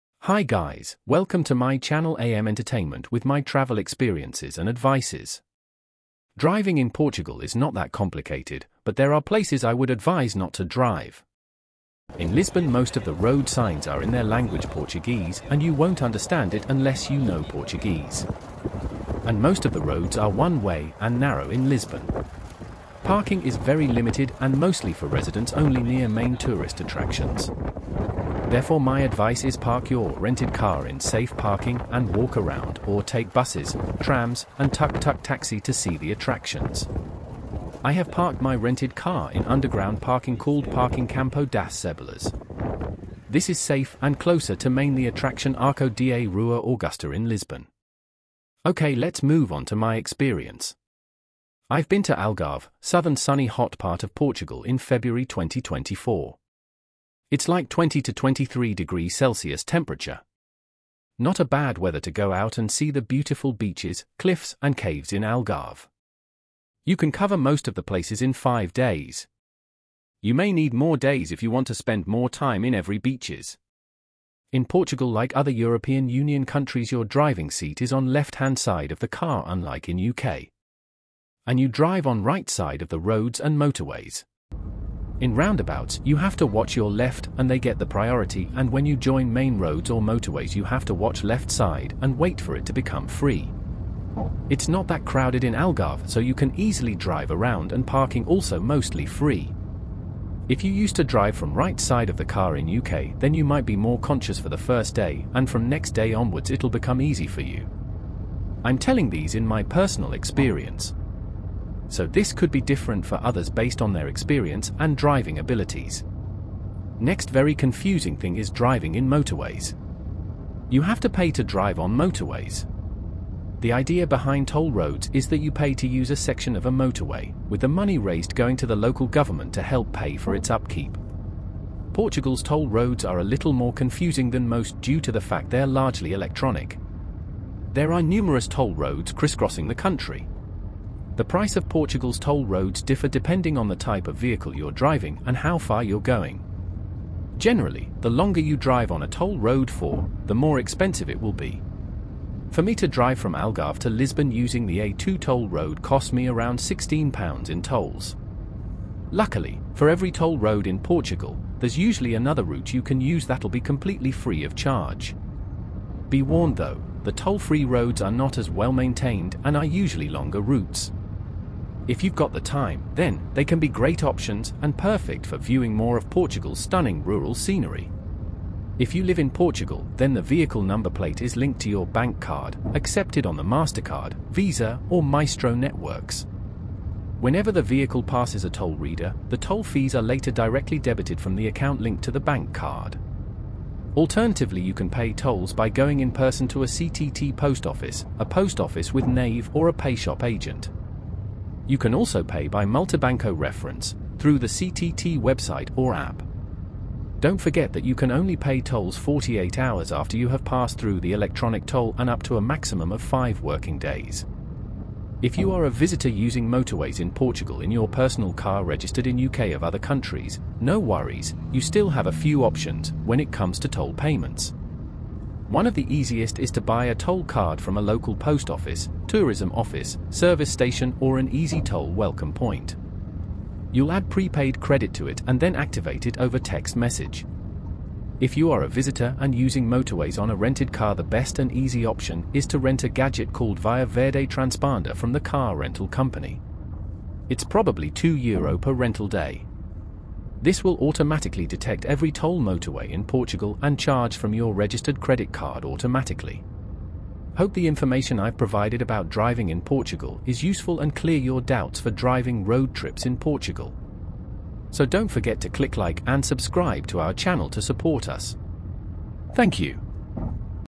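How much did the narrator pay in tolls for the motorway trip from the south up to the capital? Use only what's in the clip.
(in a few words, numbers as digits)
£16.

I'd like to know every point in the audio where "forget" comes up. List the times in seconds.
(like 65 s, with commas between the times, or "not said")
207 s, 265 s.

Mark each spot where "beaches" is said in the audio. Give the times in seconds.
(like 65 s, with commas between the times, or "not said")
63 s, 72 s.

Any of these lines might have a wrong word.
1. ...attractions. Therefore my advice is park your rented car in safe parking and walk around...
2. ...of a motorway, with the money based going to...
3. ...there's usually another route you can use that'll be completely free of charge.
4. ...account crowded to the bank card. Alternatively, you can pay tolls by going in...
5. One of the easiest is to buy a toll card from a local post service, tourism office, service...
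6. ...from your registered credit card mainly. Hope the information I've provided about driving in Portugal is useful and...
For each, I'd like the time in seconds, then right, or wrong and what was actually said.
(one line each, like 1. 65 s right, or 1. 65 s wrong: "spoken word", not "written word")
1. 26 s right
2. 126 s wrong: "raised", not "based"
3. 161 s right
4. 191 s wrong: "linked", not "crowded"
5. 225 s wrong: "office", not "service"
6. 254 s wrong: "automatically", not "mainly".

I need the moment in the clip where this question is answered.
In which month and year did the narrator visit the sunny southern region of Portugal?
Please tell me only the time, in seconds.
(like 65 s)
54 s.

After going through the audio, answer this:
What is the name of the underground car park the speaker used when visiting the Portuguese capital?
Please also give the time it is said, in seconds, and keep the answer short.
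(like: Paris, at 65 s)
Parking Campo das Cebolas, at 40 s.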